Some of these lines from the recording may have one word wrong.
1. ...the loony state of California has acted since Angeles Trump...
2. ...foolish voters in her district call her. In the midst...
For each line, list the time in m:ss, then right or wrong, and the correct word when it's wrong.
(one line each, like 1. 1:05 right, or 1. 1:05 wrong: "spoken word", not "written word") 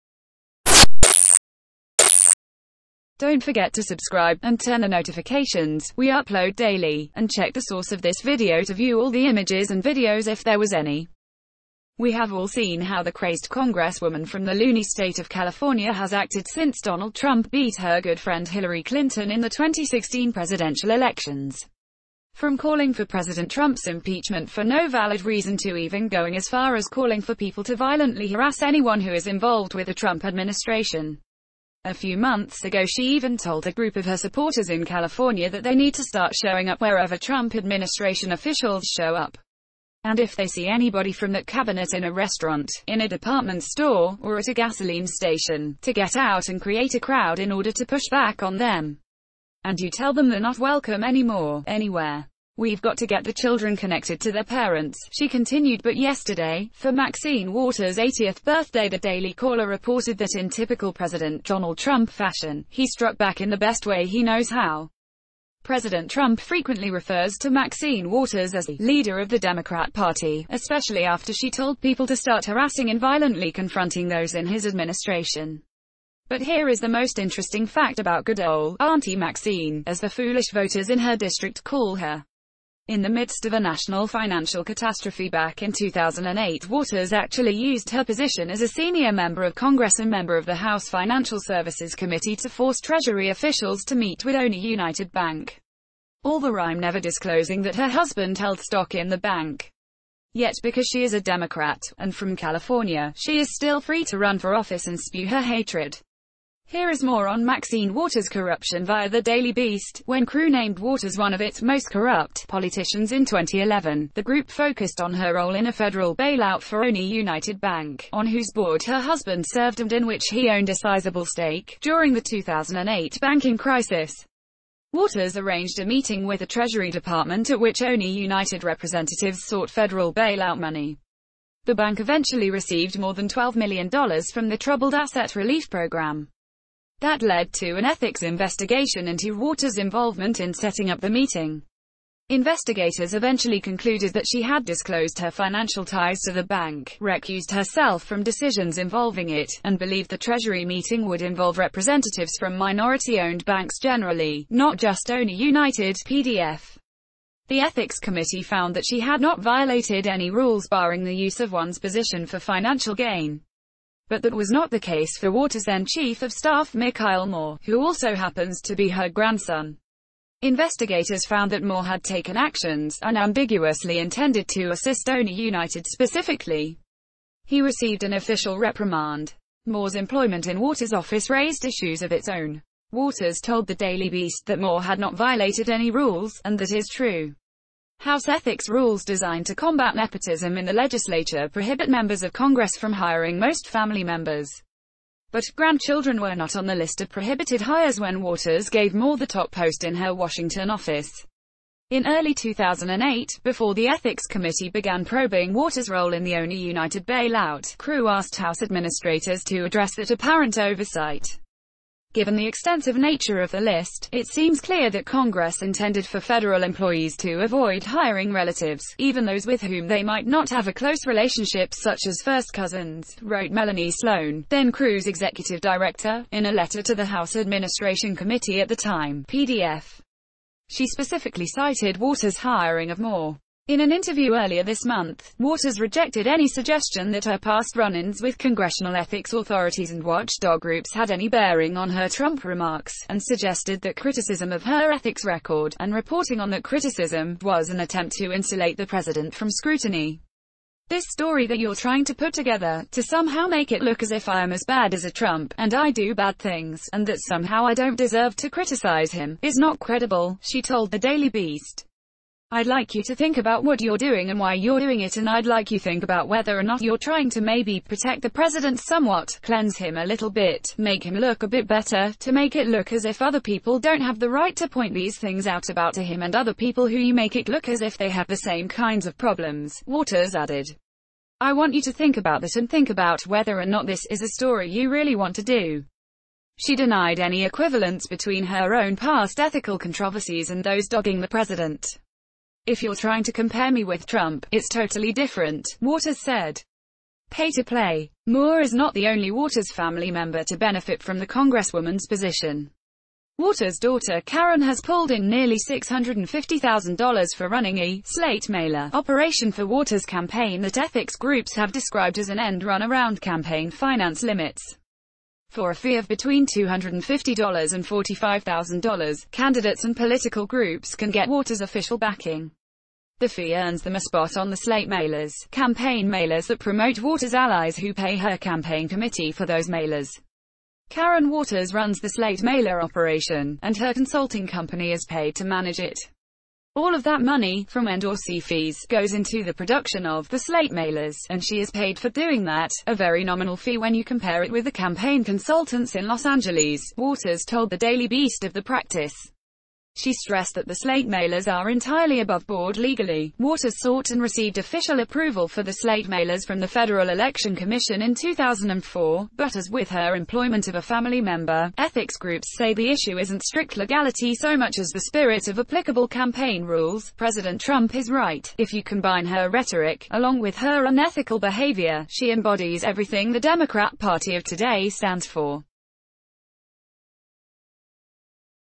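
1. 0:14 wrong: "Donald", not "Angeles"
2. 1:20 right.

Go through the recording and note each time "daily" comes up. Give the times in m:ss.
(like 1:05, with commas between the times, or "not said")
0:06, 0:58, 1:49, 3:03, 4:20, 5:47.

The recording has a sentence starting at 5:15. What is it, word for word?
For a fee of between $250 and $45,000, candidates and political groups can get Waters' official backing.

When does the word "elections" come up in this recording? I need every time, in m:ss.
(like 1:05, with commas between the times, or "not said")
0:20, 5:57.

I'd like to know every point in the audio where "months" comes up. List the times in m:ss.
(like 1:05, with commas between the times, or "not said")
0:32, 3:54.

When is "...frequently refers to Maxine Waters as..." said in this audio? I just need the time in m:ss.
1:06.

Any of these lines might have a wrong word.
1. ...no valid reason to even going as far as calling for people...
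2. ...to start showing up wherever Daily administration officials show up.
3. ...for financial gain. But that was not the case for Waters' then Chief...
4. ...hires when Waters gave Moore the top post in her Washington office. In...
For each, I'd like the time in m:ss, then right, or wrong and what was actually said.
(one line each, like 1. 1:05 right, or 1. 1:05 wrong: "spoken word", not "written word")
1. 0:24 right
2. 0:35 wrong: "Trump", not "Daily"
3. 2:42 right
4. 3:17 right.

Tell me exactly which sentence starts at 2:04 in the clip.
Waters arranged a meeting with the Treasury Department at which OneUnited representatives sought federal bailout money.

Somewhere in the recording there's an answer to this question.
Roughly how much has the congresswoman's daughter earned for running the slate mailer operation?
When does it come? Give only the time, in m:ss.
5:05.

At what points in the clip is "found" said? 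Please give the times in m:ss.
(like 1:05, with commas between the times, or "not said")
2:38, 2:51.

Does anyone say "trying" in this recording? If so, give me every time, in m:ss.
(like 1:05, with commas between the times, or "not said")
4:11, 4:26, 4:52.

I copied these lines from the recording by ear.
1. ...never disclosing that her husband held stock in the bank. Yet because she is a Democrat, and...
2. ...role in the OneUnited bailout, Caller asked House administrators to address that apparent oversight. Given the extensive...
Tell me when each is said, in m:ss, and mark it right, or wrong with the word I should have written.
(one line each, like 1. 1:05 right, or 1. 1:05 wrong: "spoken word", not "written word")
1. 1:36 right
2. 3:25 wrong: "Crew", not "Caller".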